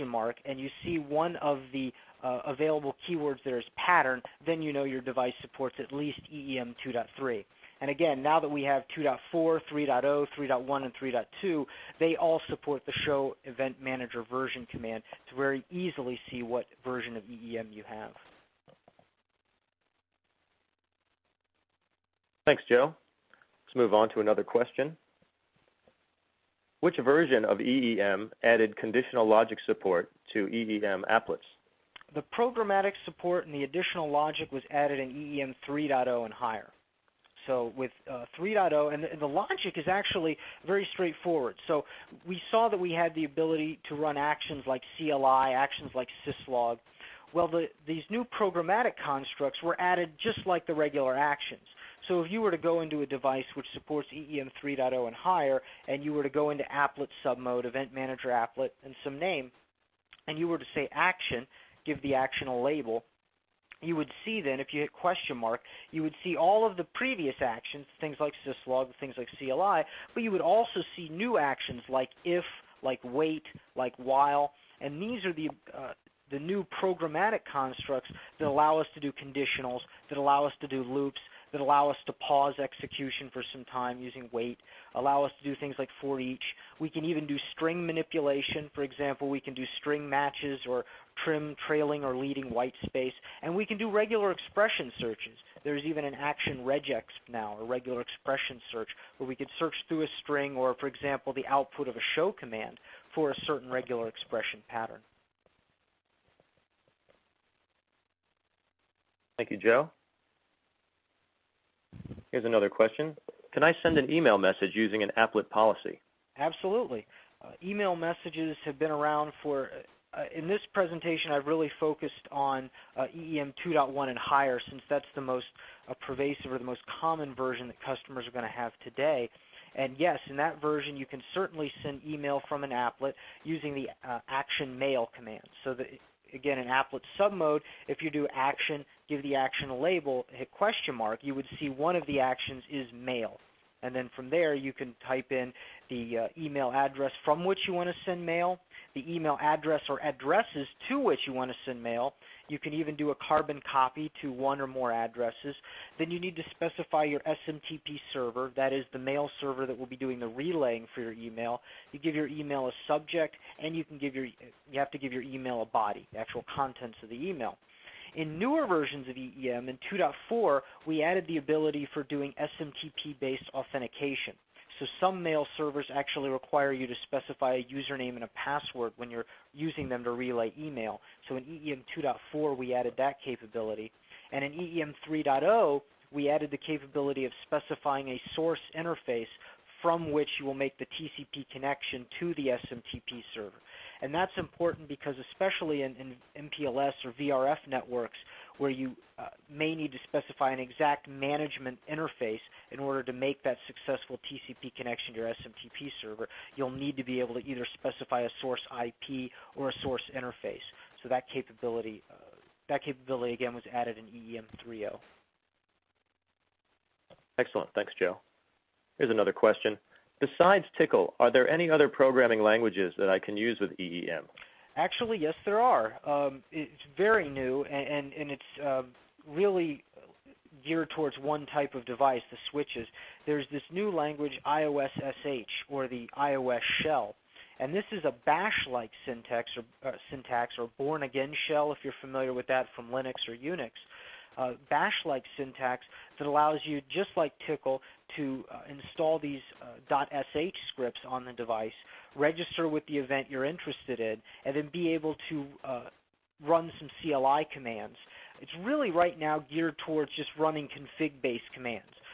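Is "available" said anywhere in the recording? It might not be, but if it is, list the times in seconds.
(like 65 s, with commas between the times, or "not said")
2 s.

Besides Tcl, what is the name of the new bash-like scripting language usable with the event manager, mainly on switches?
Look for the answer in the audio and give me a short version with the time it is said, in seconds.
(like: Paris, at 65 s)
IOS SH, at 234 s.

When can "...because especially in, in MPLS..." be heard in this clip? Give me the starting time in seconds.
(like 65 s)
194 s.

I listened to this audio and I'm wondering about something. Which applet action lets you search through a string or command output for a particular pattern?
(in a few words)
action regex.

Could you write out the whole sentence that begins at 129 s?
And yes, in that version, you can certainly send email from an applet using the uh, action mail command.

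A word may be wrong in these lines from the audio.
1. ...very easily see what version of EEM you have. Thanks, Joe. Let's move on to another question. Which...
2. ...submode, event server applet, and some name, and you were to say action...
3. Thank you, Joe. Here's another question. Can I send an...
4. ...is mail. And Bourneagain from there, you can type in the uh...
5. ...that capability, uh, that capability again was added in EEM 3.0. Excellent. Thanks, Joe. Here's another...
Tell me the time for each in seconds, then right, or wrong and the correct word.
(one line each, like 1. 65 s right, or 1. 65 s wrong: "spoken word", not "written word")
1. 15 s right
2. 57 s wrong: "manager", not "server"
3. 109 s right
4. 142 s wrong: "Then", not "Bourneagain"
5. 211 s right.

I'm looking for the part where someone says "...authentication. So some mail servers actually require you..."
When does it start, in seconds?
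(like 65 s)
173 s.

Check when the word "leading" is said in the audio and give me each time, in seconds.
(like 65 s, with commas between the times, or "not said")
92 s.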